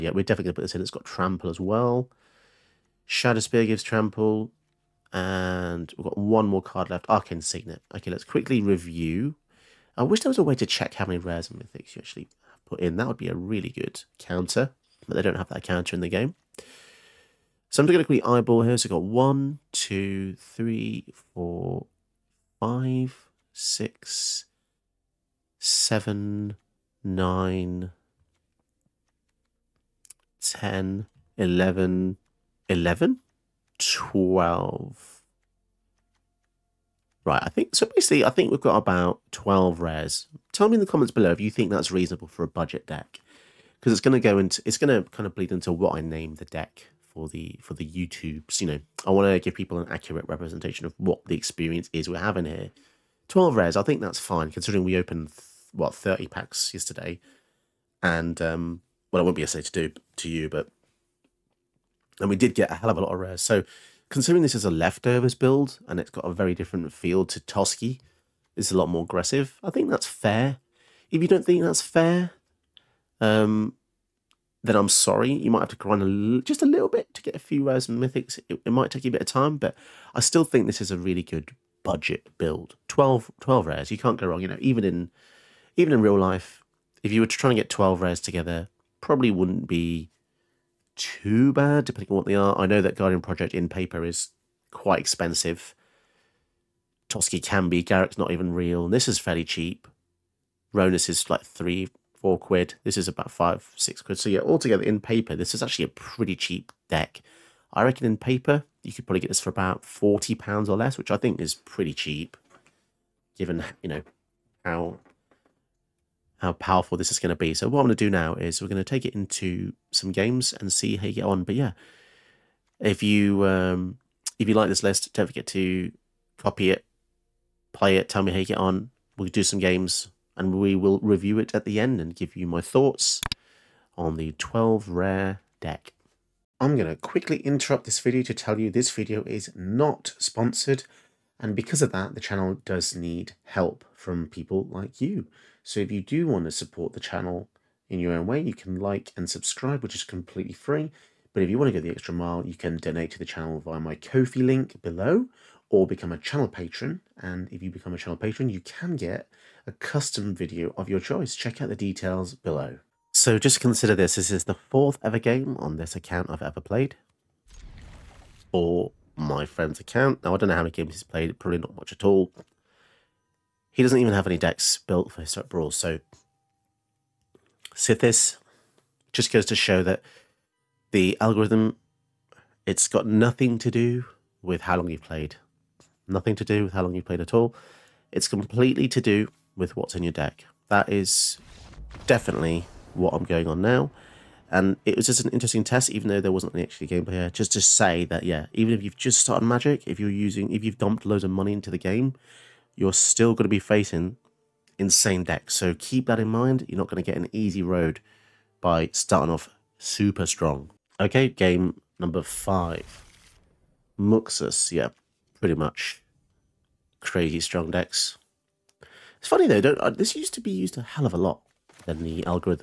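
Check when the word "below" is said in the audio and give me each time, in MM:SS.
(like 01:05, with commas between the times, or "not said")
00:41, 02:34, 02:42.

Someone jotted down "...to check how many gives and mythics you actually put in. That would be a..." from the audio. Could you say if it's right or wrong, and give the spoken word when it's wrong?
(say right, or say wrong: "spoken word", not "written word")
wrong: "rares", not "gives".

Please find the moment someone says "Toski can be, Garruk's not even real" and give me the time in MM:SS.
01:37.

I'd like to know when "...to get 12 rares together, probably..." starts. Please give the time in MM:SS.
01:27.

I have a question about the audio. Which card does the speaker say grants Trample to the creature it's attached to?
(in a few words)
Shadow Spear.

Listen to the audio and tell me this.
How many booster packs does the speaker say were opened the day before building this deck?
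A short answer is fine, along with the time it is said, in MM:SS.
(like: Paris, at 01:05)
30, at 00:55.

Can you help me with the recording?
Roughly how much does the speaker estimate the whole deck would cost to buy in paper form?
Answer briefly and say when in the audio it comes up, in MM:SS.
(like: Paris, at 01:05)
£40, at 01:49.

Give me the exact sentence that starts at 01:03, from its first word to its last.
So Considering this is a leftovers build and it's got a very different feel to Toski, it's a lot more aggressive.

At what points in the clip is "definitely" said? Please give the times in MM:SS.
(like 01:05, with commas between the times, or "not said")
00:00, 03:12.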